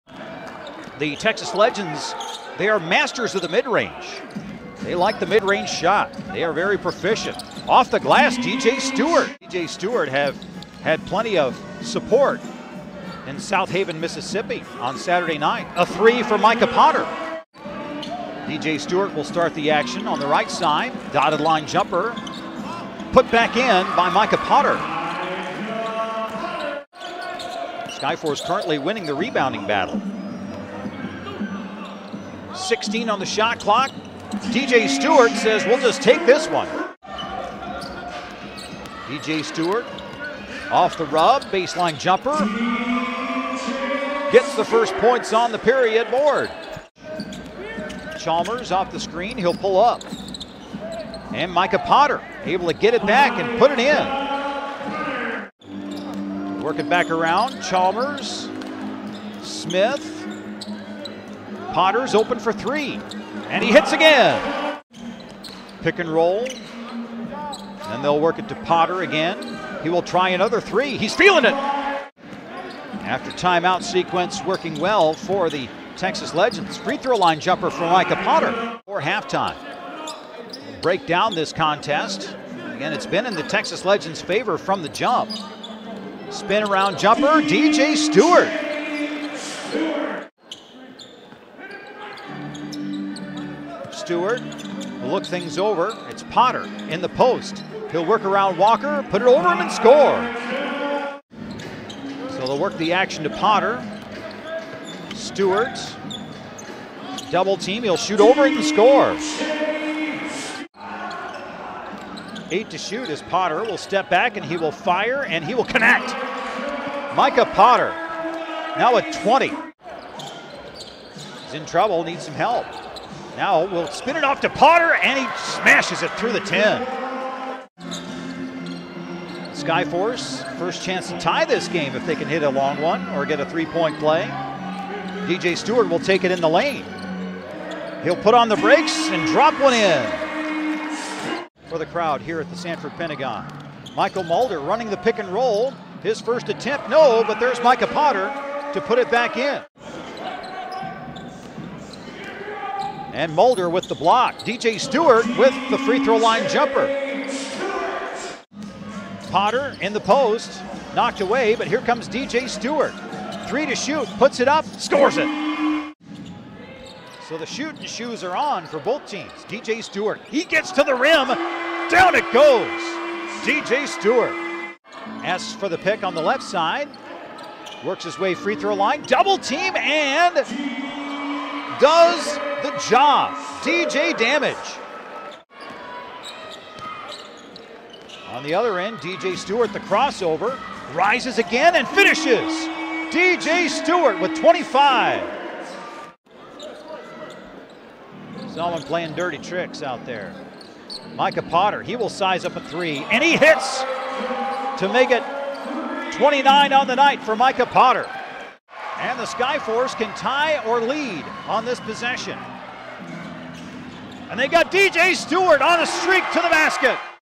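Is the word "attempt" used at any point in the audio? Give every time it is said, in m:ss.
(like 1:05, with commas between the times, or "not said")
2:26.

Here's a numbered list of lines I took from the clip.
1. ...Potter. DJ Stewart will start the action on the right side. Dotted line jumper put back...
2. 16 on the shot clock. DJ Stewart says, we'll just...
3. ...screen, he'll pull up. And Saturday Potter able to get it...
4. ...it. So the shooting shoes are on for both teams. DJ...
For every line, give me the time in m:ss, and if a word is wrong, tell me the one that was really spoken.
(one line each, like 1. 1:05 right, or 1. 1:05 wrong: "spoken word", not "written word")
1. 0:16 right
2. 0:32 right
3. 0:48 wrong: "Micah", not "Saturday"
4. 2:45 right.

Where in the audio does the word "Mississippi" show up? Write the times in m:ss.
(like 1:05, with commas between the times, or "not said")
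0:13.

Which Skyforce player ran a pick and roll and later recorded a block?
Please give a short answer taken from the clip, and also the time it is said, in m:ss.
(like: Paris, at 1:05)
Mychal Mulder, at 2:23.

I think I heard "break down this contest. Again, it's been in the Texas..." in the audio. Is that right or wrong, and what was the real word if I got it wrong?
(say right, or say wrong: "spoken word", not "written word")
right.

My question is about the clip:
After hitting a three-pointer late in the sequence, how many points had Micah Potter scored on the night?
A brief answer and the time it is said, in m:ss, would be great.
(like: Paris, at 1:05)
29, at 3:26.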